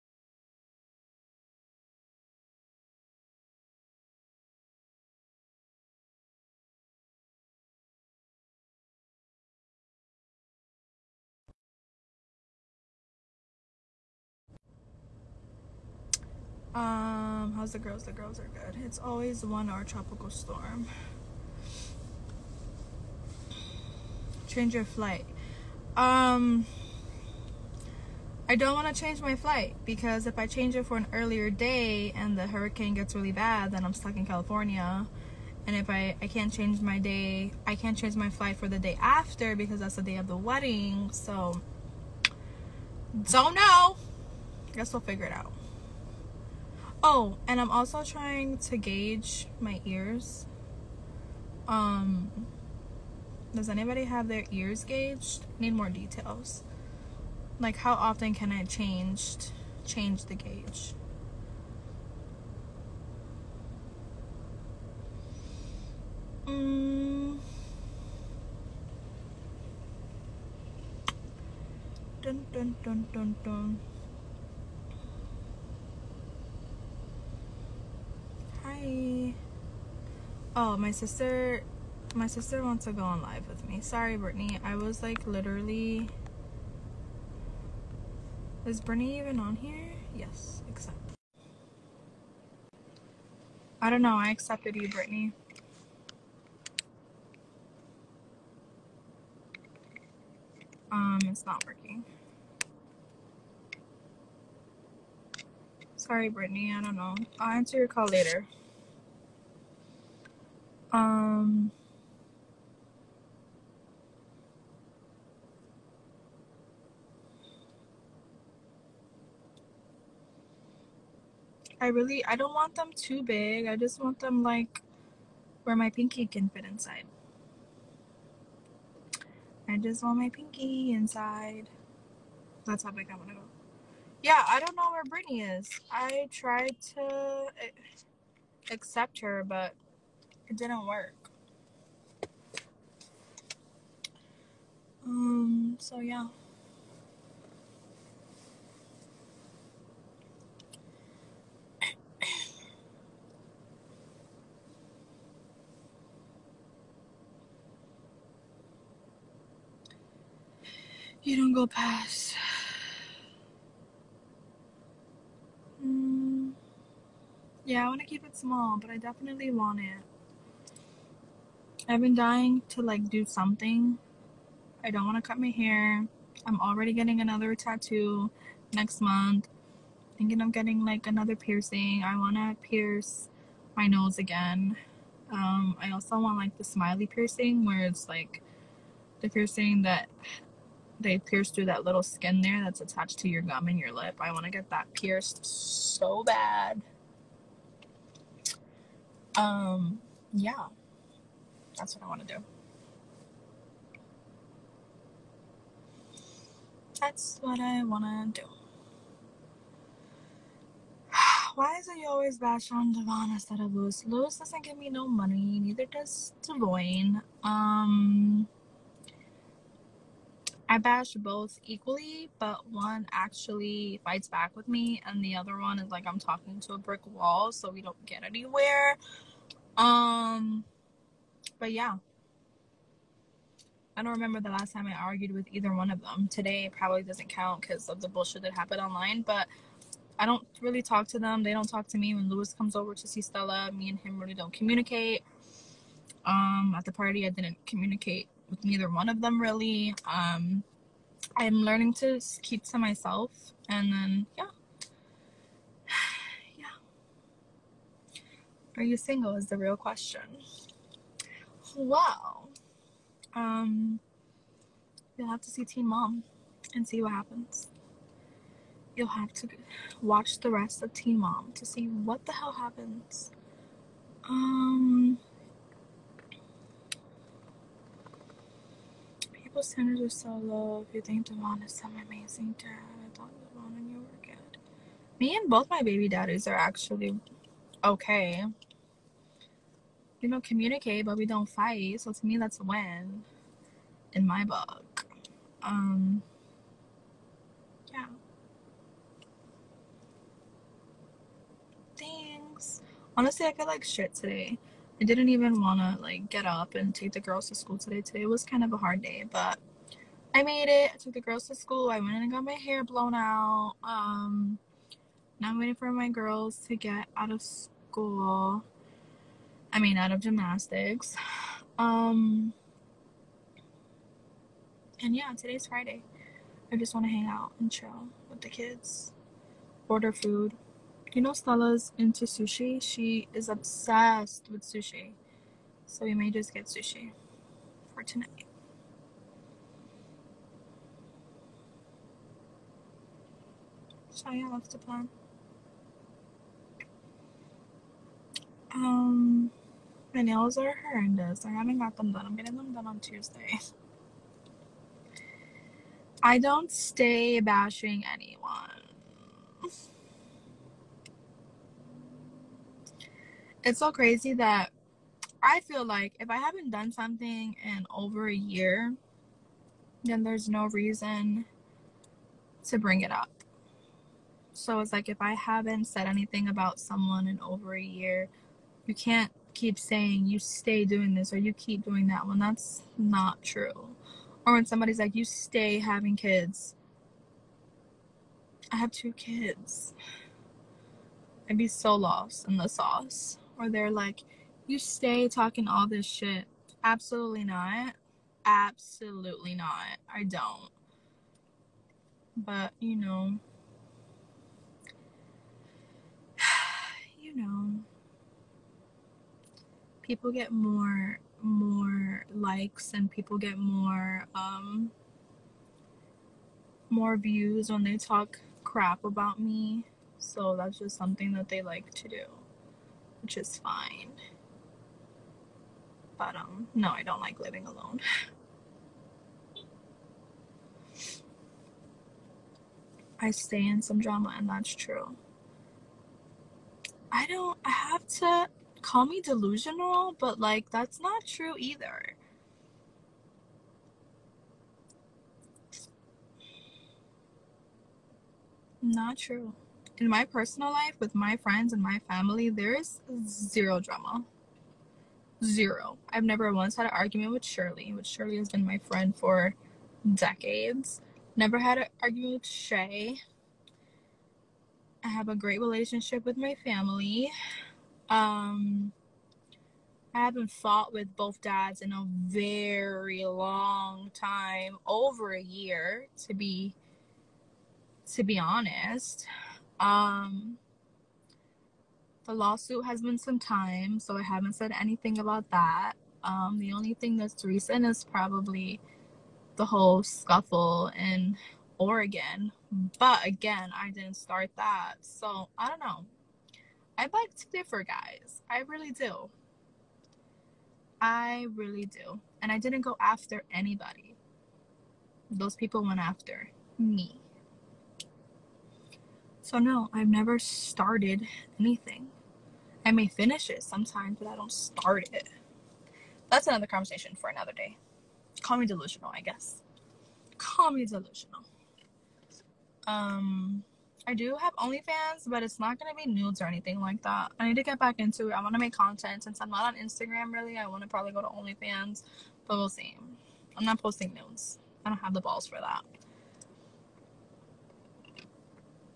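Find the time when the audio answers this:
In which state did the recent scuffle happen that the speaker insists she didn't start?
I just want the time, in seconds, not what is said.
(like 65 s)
491 s.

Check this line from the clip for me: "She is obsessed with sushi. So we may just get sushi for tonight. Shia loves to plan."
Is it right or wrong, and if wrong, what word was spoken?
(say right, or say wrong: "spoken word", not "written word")
right.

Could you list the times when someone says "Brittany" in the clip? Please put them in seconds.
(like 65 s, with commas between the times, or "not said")
84 s, 94 s, 106 s, 135 s.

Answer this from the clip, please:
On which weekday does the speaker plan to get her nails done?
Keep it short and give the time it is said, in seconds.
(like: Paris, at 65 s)
Tuesday, at 352 s.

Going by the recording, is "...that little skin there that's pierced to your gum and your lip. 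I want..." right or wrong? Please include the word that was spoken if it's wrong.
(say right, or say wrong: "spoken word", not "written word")
wrong: "attached", not "pierced".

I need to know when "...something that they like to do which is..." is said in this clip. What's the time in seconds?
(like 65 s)
420 s.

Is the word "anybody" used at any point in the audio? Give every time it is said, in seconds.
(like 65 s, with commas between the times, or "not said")
53 s, 503 s.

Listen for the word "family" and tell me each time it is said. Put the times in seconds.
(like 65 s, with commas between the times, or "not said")
452 s, 466 s.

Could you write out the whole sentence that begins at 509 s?
So, no, I've never started anything.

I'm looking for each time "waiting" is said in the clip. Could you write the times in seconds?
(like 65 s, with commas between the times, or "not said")
315 s.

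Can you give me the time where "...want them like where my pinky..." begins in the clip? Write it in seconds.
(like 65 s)
124 s.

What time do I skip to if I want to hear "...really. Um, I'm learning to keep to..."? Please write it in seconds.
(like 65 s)
249 s.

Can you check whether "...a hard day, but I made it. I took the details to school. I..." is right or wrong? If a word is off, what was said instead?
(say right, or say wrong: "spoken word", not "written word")
wrong: "girls", not "details".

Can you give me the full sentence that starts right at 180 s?
Thinking of getting like another piercing.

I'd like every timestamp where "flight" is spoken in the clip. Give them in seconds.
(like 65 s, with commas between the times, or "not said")
24 s, 29 s, 38 s.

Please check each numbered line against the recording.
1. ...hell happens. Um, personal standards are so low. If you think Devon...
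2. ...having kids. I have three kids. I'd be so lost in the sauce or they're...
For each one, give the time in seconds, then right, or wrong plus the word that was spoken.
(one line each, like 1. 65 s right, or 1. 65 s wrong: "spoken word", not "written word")
1. 272 s wrong: "local", not "personal"
2. 385 s wrong: "two", not "three".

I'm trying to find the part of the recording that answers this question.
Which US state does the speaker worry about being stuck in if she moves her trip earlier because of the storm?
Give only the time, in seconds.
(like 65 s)
34 s.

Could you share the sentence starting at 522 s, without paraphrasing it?
Um, I do have OnlyFans, but it's not gonna be nudes or anything like that.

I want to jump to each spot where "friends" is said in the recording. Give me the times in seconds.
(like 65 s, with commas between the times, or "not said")
451 s, 458 s.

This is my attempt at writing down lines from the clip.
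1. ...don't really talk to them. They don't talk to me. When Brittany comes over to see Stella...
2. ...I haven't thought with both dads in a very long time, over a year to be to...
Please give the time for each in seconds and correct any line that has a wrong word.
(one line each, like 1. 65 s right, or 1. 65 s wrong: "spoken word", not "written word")
1. 240 s wrong: "Luis", not "Brittany"
2. 470 s wrong: "fought", not "thought".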